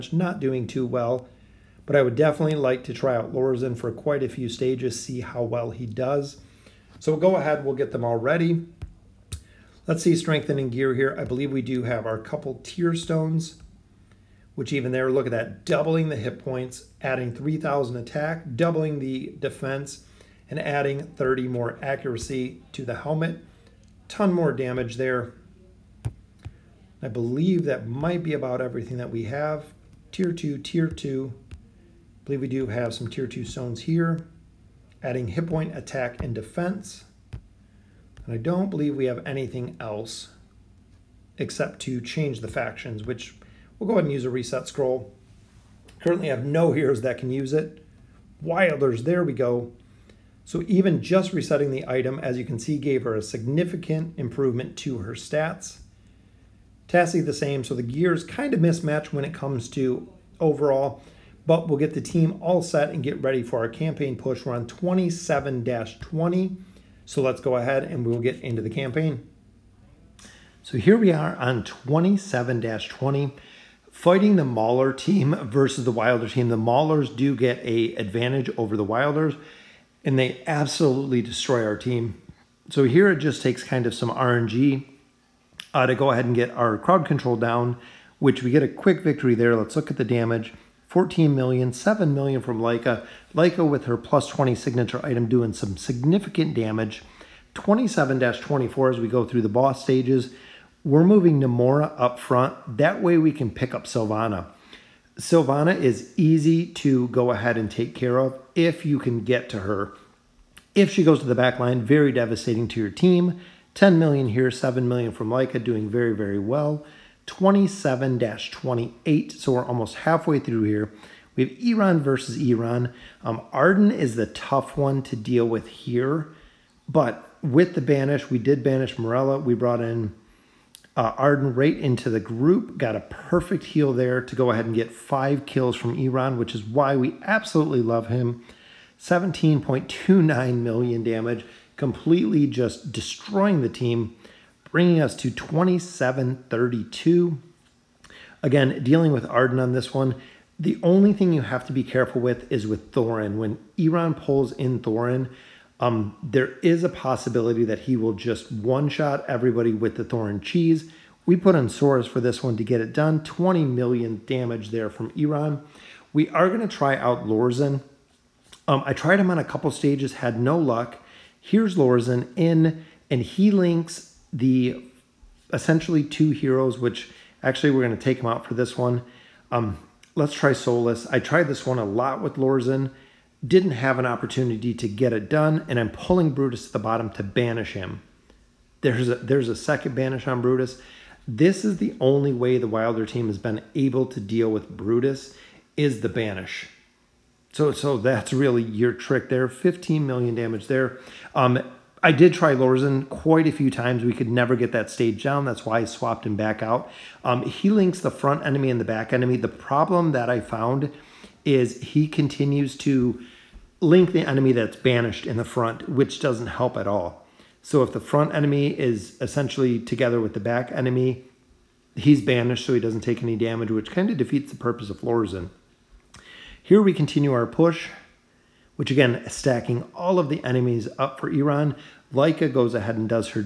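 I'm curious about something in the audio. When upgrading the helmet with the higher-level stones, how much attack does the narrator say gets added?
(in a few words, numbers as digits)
3,000.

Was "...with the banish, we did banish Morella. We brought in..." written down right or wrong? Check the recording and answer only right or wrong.
right.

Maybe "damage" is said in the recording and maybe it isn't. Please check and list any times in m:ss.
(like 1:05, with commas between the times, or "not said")
0:24, 1:30, 1:36, 2:21, 2:44, 3:20, 3:43.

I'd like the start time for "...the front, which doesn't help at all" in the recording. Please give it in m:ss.
3:35.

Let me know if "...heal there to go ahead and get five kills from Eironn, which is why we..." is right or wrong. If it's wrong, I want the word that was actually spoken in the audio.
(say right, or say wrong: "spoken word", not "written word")
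right.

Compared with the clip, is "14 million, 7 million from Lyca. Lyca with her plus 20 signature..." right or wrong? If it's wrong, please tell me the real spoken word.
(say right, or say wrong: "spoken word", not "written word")
right.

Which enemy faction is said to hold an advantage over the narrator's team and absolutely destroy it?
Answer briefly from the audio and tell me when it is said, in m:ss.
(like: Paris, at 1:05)
Maulers, at 1:16.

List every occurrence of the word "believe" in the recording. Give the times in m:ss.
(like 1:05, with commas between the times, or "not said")
0:11, 0:27, 0:32, 0:38.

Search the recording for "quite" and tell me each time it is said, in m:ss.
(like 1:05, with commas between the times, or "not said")
0:03, 3:23.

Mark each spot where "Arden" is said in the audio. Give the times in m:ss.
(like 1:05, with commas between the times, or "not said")
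2:03, 2:11, 2:29.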